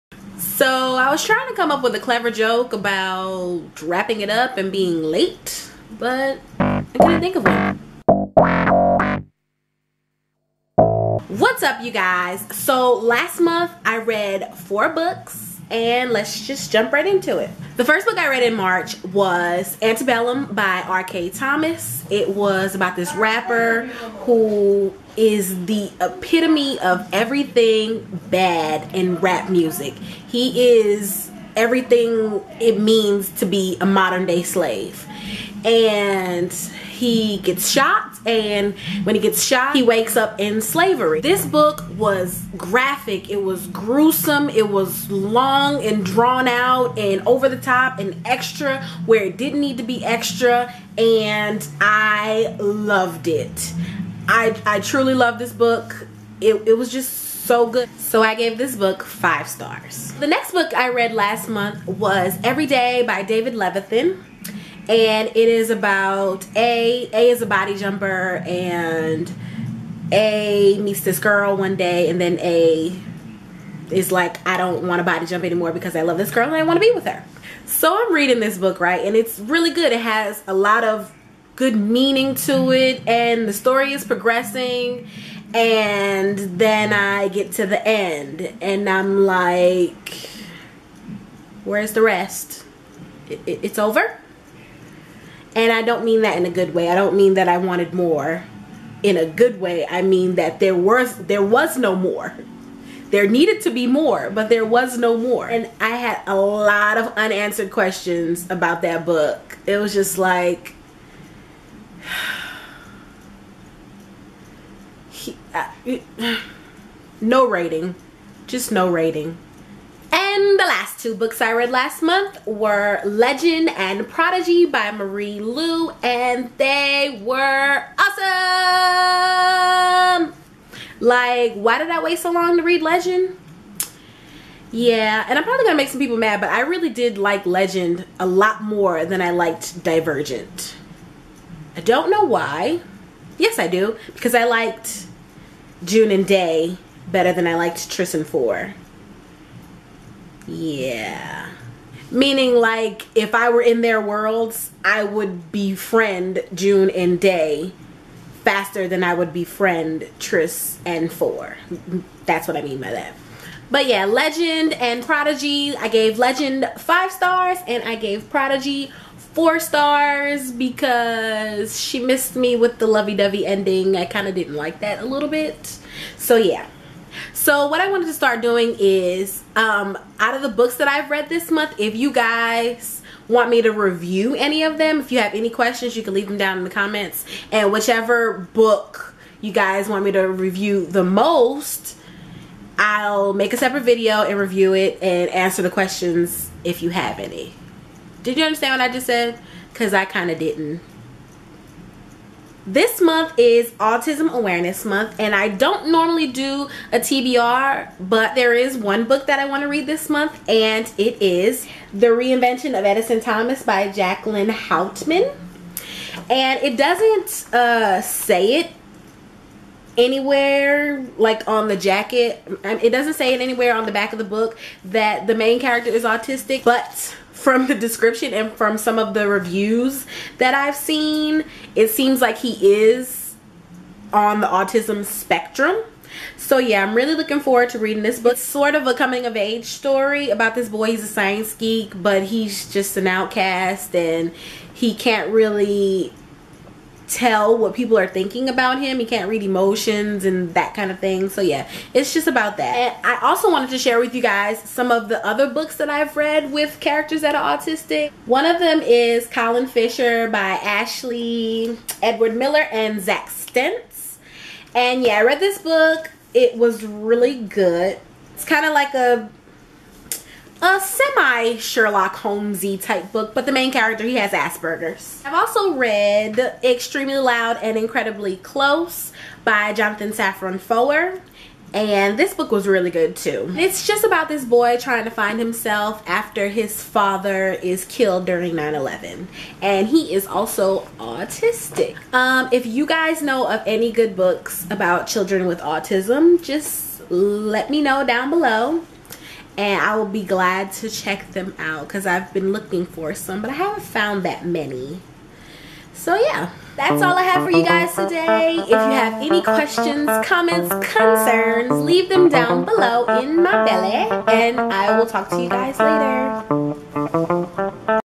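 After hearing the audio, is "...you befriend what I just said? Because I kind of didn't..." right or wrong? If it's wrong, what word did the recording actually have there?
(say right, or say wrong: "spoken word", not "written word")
wrong: "understand", not "befriend".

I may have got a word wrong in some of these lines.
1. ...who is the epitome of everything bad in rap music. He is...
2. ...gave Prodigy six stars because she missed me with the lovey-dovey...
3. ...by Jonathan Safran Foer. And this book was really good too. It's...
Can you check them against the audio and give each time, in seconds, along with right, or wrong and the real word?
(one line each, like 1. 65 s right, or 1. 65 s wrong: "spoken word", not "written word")
1. 24 s right
2. 167 s wrong: "four", not "six"
3. 279 s right.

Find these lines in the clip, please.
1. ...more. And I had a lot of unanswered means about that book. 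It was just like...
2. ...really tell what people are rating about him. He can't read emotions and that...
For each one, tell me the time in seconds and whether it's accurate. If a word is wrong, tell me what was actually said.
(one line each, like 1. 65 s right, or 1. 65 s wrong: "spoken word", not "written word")
1. 105 s wrong: "questions", not "means"
2. 245 s wrong: "thinking", not "rating".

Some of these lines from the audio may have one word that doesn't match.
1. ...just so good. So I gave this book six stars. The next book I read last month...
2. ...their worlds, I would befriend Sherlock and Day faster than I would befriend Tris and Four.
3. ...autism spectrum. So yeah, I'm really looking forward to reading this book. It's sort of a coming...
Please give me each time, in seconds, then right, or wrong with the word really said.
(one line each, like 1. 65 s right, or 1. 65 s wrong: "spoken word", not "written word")
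1. 56 s wrong: "five", not "six"
2. 153 s wrong: "June", not "Sherlock"
3. 234 s right.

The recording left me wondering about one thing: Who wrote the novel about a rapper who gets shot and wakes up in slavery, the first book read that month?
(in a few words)
R. Kayeen Thomas.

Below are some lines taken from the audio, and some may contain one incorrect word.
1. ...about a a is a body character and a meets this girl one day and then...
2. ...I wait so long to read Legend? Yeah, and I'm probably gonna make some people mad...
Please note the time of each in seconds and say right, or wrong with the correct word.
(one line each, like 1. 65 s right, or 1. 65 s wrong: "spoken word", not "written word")
1. 65 s wrong: "jumper", not "character"
2. 131 s right.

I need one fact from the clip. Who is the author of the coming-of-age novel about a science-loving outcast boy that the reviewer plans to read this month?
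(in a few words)
Jacqueline Houtman.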